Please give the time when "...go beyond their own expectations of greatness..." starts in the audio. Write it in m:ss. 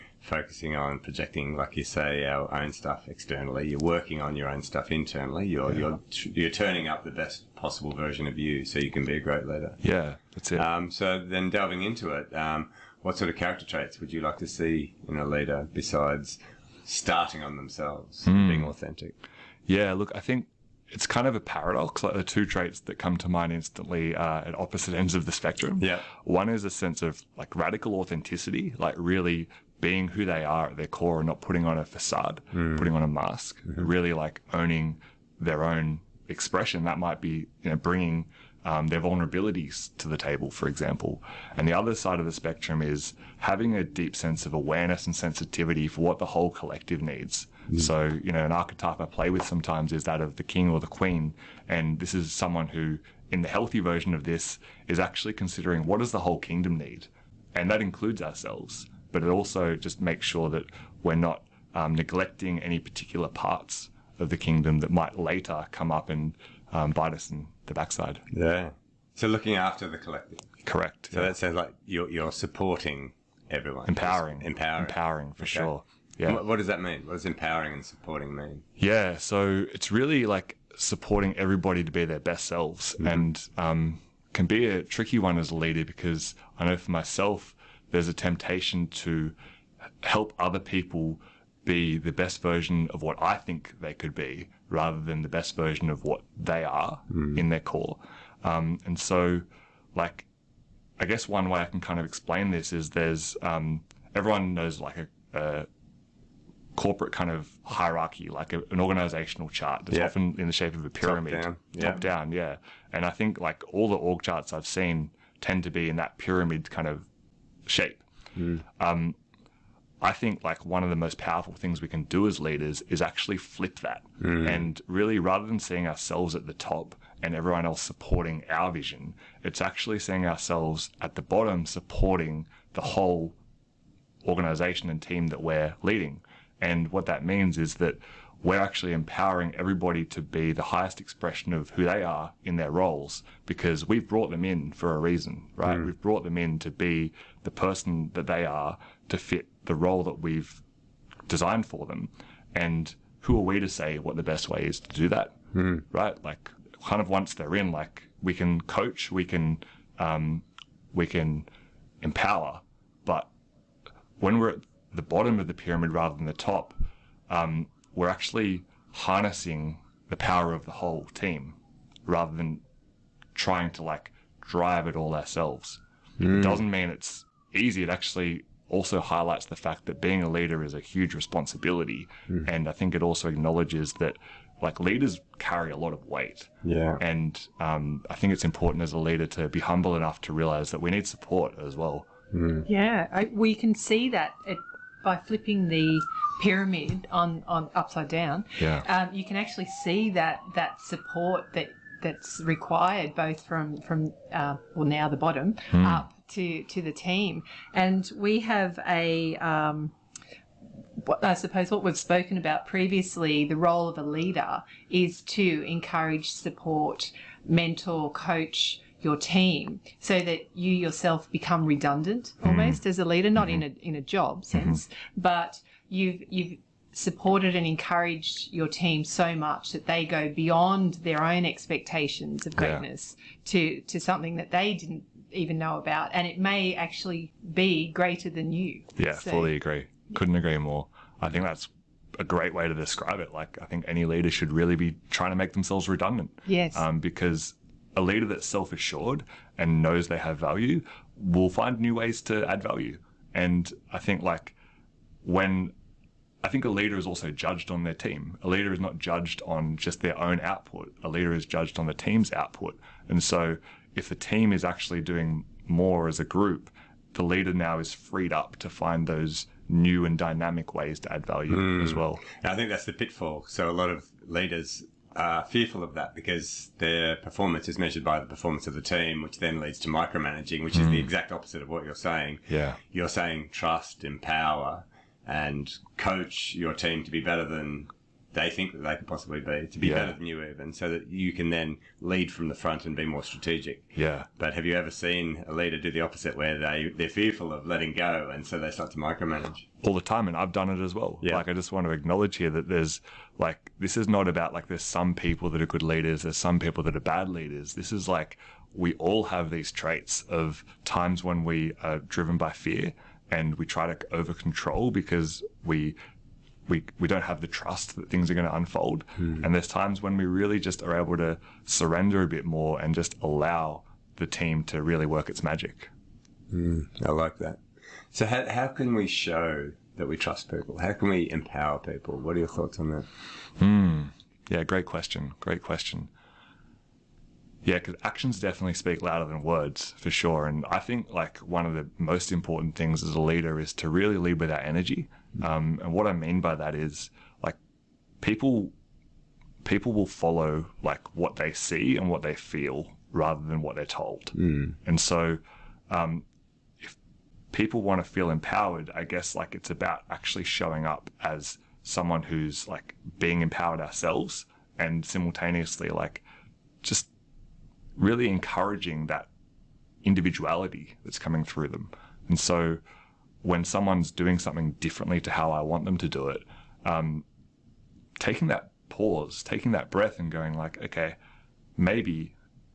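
3:50.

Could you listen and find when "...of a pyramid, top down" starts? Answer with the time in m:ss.
1:50.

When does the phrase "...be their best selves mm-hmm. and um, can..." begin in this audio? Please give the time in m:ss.
1:21.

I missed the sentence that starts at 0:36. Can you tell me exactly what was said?
That might be you know, bringing um, their vulnerabilities to the table, for example.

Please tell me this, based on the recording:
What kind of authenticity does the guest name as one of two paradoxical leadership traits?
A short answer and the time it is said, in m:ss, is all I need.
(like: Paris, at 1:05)
Radical authenticity, at 0:27.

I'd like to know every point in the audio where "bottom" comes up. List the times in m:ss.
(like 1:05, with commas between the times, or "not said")
2:11, 2:45, 3:25.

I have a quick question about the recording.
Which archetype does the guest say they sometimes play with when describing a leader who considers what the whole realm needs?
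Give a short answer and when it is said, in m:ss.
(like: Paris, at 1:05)
The king or the queen, at 0:50.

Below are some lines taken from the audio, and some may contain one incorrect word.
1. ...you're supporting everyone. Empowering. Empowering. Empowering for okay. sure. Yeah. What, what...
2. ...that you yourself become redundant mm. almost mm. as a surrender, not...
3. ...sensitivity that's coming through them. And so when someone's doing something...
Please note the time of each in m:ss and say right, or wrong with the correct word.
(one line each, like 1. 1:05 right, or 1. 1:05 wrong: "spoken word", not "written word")
1. 1:12 right
2. 3:40 wrong: "leader", not "surrender"
3. 6:10 wrong: "individuality", not "sensitivity".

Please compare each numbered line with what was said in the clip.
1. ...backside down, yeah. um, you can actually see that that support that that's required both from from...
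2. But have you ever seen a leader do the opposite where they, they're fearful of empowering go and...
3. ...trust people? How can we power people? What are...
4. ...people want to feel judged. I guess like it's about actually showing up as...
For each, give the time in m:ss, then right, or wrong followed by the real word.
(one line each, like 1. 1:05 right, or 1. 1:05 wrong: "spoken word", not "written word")
1. 3:17 wrong: "upside", not "backside"
2. 4:54 wrong: "letting", not "empowering"
3. 5:30 wrong: "empower", not "power"
4. 5:57 wrong: "empowered", not "judged".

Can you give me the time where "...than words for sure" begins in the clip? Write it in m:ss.
5:39.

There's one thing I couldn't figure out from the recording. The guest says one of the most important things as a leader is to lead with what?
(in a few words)
Our energy.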